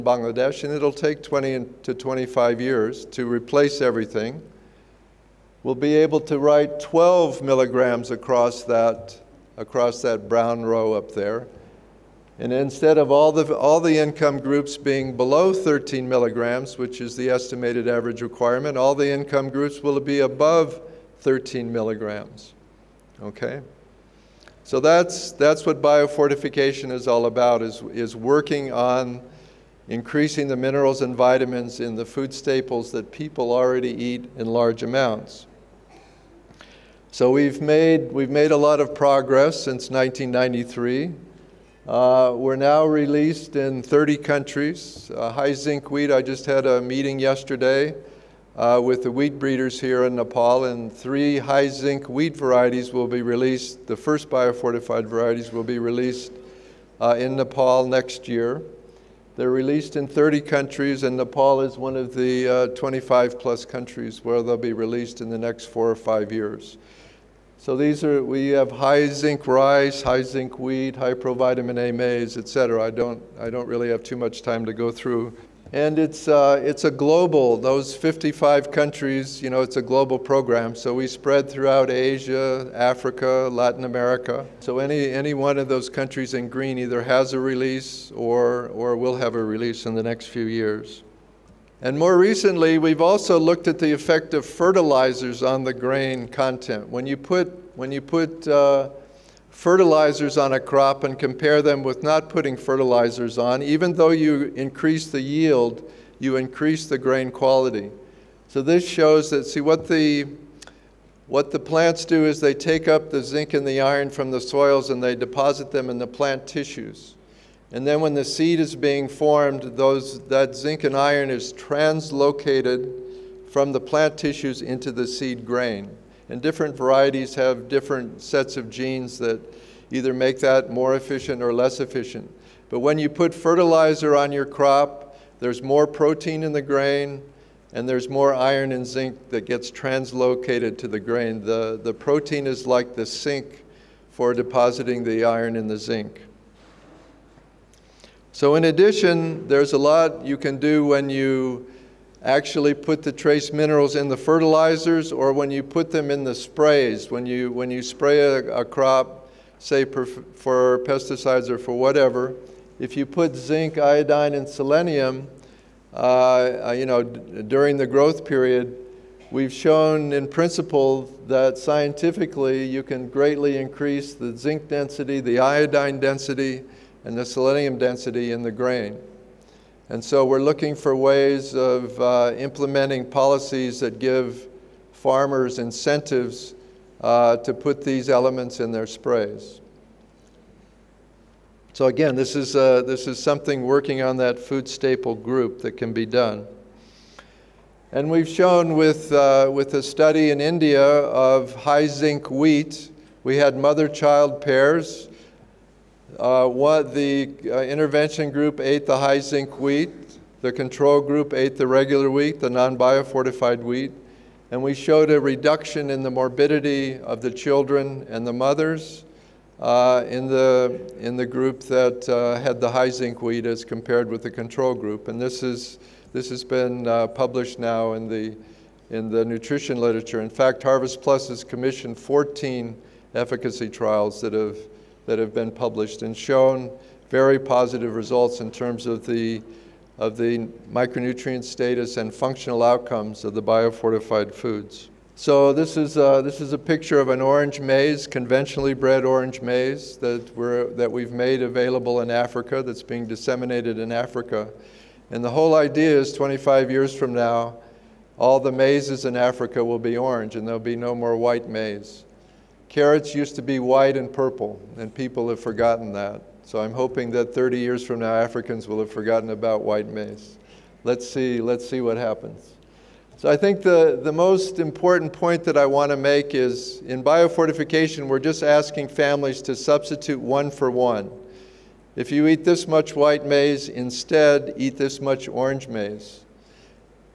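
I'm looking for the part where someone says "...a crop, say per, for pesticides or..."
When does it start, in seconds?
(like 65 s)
158 s.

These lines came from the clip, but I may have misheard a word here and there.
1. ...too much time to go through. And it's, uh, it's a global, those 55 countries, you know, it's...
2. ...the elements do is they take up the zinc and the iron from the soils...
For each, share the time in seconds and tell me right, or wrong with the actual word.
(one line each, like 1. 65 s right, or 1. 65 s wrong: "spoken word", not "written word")
1. 74 s right
2. 111 s wrong: "plants", not "elements".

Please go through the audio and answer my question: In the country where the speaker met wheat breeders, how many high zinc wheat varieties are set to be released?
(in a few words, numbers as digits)
3.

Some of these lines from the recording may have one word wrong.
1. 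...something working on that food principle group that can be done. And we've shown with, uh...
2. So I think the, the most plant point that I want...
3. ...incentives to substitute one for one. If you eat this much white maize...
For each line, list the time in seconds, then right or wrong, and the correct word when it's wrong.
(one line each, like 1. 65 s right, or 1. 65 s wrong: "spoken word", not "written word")
1. 193 s wrong: "staple", not "principle"
2. 273 s wrong: "important", not "plant"
3. 278 s wrong: "families", not "incentives".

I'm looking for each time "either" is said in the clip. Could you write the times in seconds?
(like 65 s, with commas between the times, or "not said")
86 s, 129 s.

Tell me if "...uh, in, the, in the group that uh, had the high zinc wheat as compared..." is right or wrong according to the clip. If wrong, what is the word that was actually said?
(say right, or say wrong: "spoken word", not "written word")
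right.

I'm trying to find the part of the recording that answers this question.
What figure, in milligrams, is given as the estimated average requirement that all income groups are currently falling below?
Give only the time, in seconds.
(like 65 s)
15 s.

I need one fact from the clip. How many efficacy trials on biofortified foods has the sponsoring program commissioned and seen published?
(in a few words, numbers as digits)
14.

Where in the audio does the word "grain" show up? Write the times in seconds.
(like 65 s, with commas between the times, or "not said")
95 s, 106 s, 125 s, 136 s, 141 s, 178 s.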